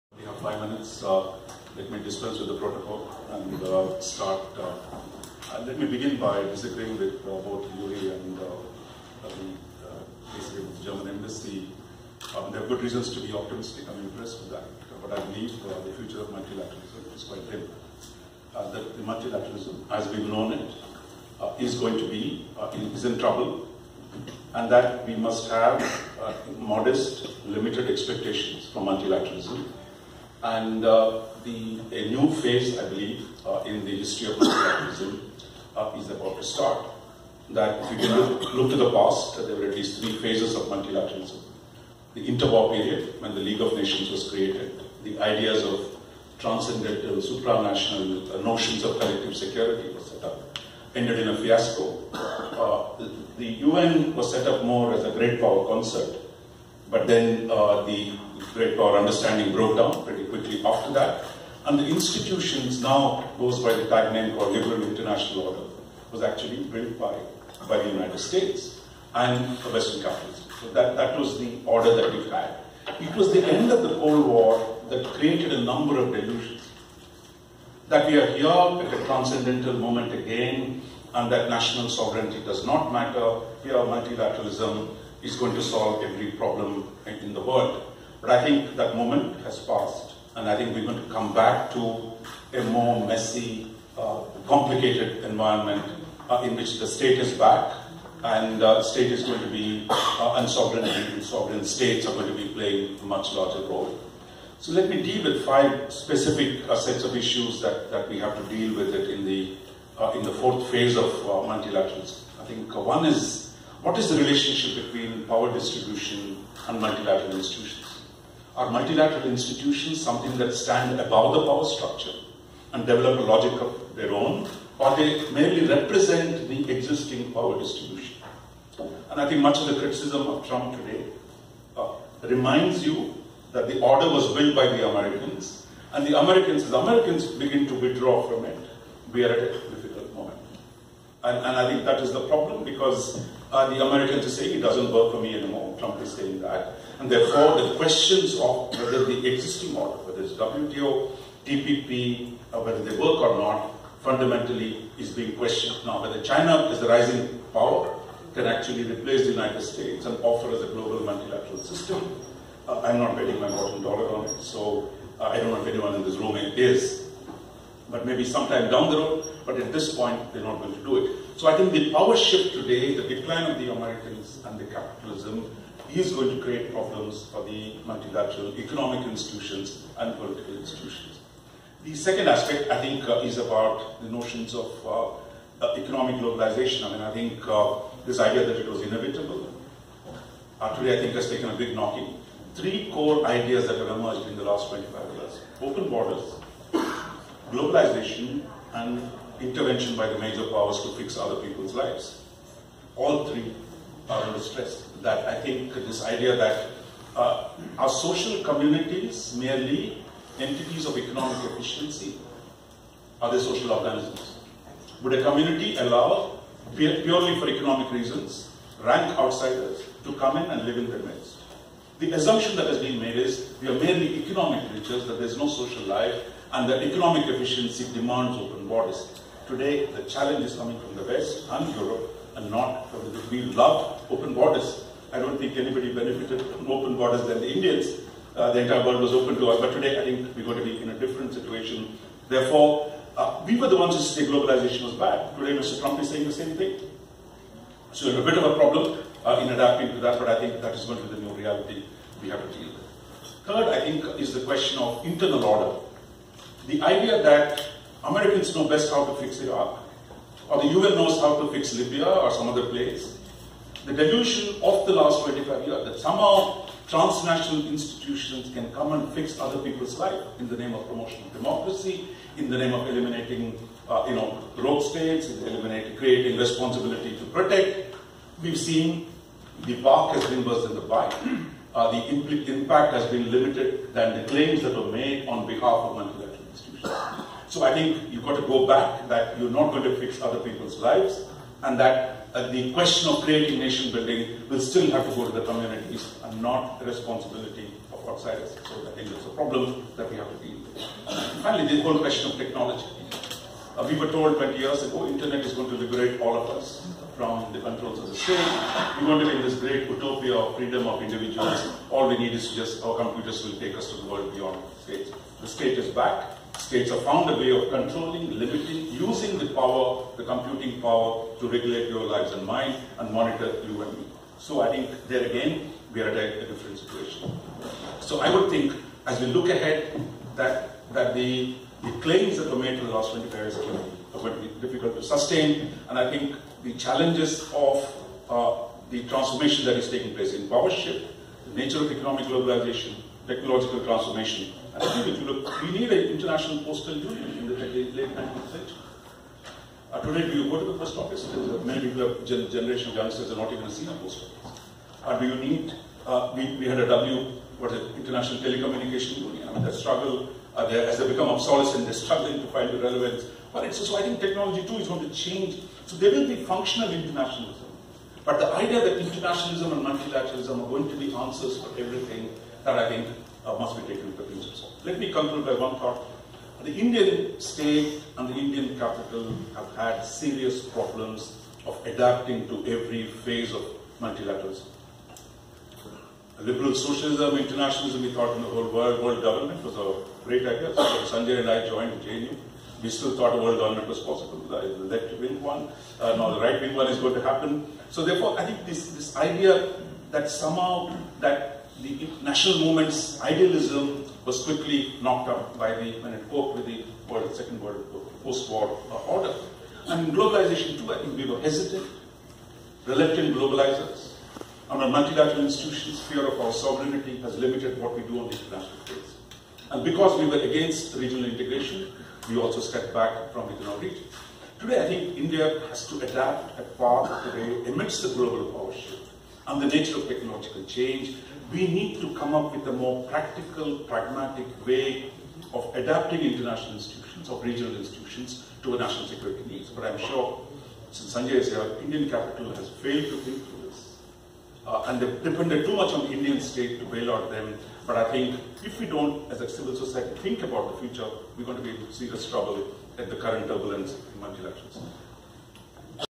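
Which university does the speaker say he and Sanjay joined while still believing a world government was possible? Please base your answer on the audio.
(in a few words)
JNU.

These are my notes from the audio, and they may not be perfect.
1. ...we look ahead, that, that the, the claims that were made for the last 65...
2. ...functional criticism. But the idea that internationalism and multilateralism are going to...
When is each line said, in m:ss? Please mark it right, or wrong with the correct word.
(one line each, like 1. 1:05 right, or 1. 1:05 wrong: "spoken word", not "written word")
1. 5:29 wrong: "25", not "65"
2. 6:06 wrong: "internationalism", not "criticism".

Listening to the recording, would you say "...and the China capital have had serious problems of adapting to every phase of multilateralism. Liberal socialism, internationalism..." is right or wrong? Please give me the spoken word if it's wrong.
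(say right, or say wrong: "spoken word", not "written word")
wrong: "Indian", not "China".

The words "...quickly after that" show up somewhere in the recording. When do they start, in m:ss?
1:00.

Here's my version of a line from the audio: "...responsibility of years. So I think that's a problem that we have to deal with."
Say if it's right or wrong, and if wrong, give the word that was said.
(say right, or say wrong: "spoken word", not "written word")
wrong: "outsiders", not "years".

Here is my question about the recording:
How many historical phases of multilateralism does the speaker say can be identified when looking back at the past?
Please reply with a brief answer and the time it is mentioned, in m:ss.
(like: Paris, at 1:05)
3, at 0:40.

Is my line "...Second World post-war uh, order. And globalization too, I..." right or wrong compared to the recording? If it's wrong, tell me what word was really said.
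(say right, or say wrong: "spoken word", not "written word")
right.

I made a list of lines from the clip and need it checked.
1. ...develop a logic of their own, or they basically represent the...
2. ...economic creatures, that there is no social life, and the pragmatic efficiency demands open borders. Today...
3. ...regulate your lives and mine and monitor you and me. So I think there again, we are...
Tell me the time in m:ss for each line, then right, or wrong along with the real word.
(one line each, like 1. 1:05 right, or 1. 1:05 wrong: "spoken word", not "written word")
1. 2:02 wrong: "merely", not "basically"
2. 3:44 wrong: "economic", not "pragmatic"
3. 5:21 right.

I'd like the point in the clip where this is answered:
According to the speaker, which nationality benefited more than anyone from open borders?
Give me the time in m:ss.
3:57.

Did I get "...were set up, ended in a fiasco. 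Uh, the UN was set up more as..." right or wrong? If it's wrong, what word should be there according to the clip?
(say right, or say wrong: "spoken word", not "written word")
right.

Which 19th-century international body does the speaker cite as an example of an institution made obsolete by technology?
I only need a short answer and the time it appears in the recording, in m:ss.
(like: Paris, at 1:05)
International postal union, at 5:46.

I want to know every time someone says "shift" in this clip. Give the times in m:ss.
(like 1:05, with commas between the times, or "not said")
2:52, 5:40, 7:08.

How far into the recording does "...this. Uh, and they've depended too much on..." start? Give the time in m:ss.
7:23.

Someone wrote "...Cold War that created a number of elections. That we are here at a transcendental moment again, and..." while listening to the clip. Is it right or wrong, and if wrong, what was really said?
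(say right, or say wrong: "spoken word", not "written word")
wrong: "delusions", not "elections".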